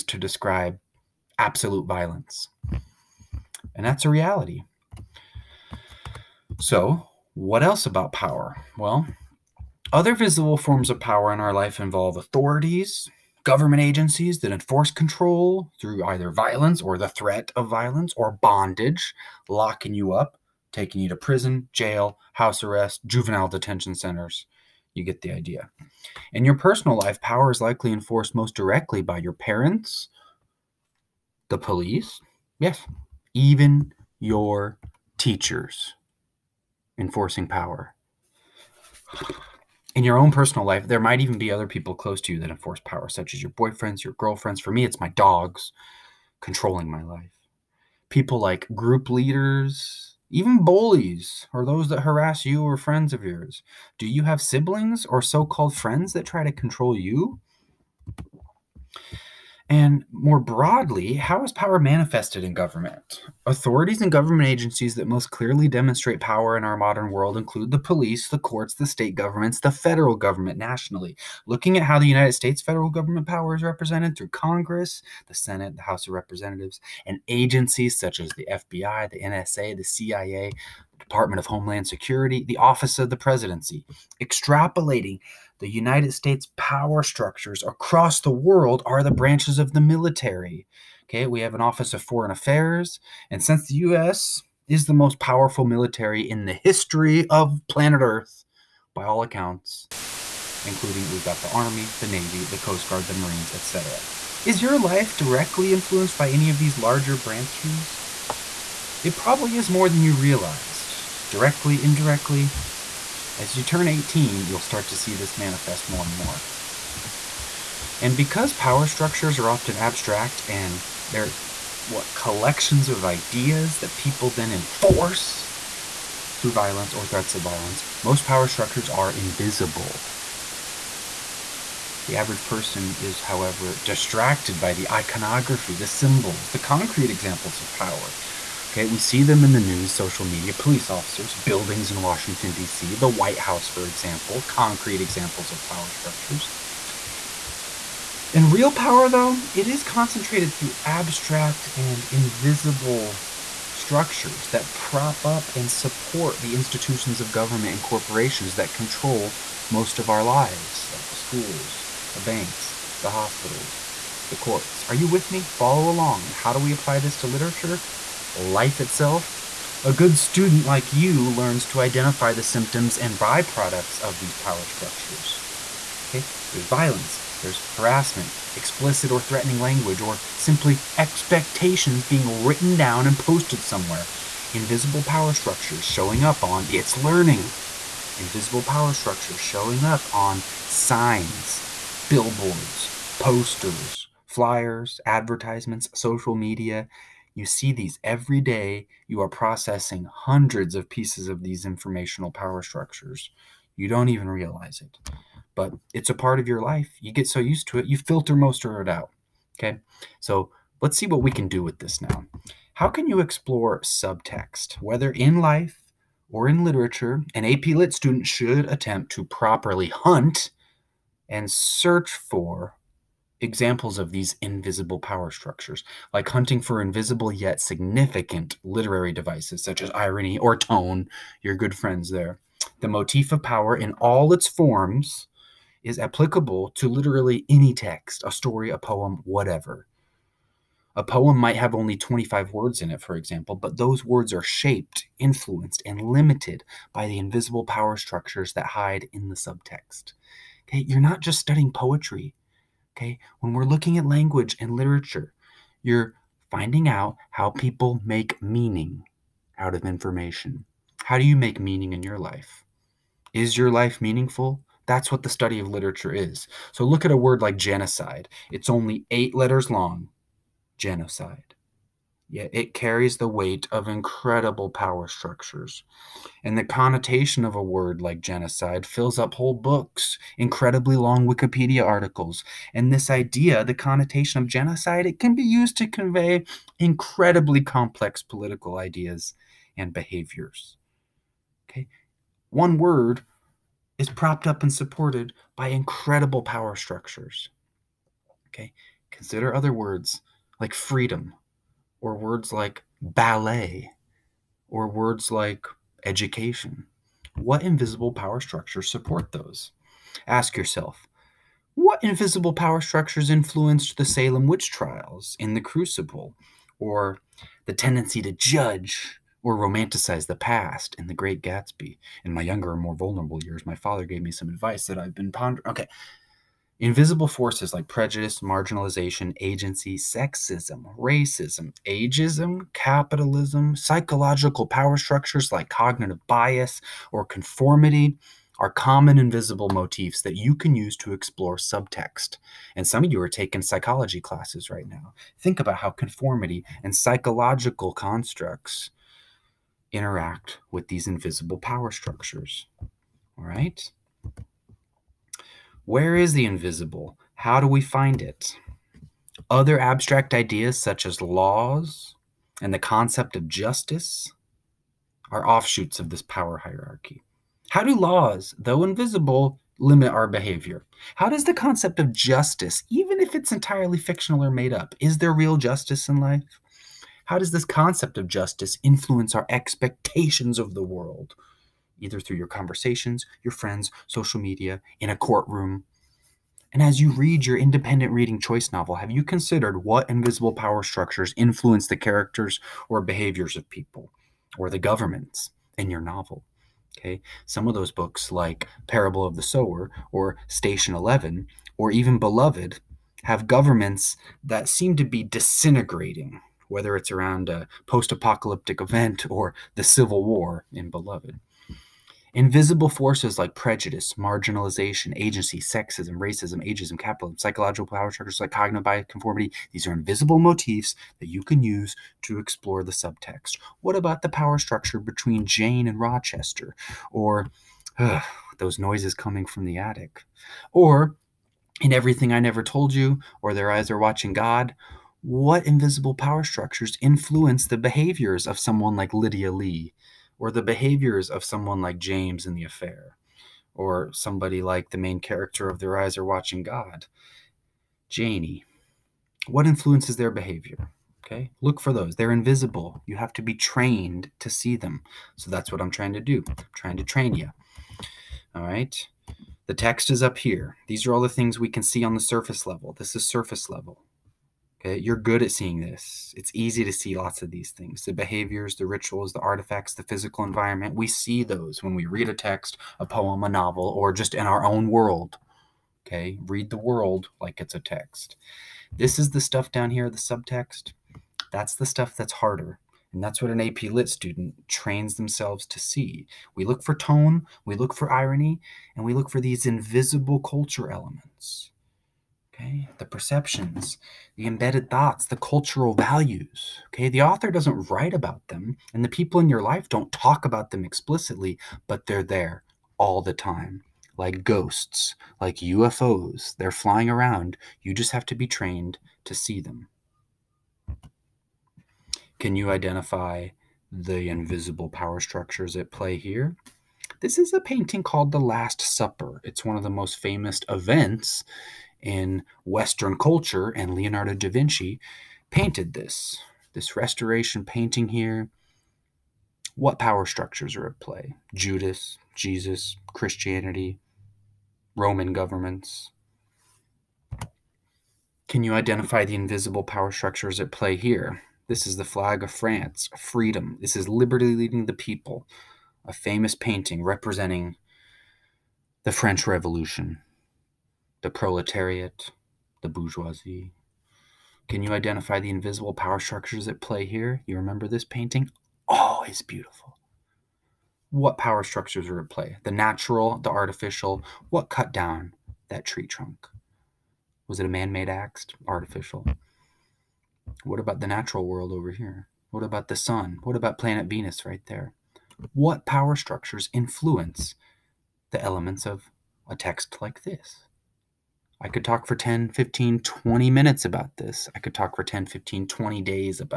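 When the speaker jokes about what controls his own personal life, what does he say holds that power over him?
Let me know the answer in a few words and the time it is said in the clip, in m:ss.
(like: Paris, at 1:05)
My dogs, at 0:44.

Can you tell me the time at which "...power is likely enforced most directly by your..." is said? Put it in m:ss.
0:27.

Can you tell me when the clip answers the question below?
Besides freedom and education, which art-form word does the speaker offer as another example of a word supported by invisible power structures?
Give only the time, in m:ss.
5:03.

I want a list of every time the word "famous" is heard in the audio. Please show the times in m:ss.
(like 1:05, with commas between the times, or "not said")
8:40, 9:06.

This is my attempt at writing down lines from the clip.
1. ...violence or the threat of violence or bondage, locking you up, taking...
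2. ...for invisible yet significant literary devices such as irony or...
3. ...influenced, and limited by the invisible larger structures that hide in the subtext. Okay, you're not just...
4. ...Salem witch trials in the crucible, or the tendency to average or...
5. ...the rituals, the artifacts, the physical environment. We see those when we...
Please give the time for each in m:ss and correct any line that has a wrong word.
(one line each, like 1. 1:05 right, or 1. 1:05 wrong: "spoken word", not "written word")
1. 0:16 right
2. 3:46 right
3. 4:05 wrong: "power", not "larger"
4. 5:14 wrong: "judge", not "average"
5. 7:48 right.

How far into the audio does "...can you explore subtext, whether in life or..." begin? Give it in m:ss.
3:32.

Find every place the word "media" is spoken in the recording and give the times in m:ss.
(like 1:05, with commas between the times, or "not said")
2:20, 3:16, 6:24.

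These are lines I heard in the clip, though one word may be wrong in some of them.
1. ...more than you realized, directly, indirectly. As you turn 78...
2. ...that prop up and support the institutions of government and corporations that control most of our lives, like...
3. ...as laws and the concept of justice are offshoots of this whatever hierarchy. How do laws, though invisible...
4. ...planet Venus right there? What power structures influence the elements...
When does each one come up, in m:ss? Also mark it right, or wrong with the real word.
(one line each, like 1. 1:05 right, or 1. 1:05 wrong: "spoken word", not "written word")
1. 1:49 wrong: "18", not "78"
2. 2:34 right
3. 6:01 wrong: "power", not "whatever"
4. 9:33 right.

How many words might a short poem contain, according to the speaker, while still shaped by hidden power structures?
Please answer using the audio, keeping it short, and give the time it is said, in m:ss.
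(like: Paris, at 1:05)
25, at 4:01.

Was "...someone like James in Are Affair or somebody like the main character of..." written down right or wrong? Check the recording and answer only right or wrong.
wrong.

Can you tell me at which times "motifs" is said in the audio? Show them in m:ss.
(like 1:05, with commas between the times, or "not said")
3:52, 5:39, 7:00.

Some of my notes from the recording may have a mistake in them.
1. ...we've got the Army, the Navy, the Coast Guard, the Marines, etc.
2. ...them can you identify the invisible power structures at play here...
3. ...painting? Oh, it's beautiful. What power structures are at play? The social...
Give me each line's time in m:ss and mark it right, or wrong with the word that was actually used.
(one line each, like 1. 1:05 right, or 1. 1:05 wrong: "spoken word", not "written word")
1. 1:41 right
2. 8:29 right
3. 9:18 wrong: "natural", not "social".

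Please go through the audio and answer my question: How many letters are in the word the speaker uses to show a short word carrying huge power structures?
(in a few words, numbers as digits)
8.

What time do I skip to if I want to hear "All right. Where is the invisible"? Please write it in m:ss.
5:52.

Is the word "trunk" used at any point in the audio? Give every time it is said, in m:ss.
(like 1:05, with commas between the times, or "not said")
9:26.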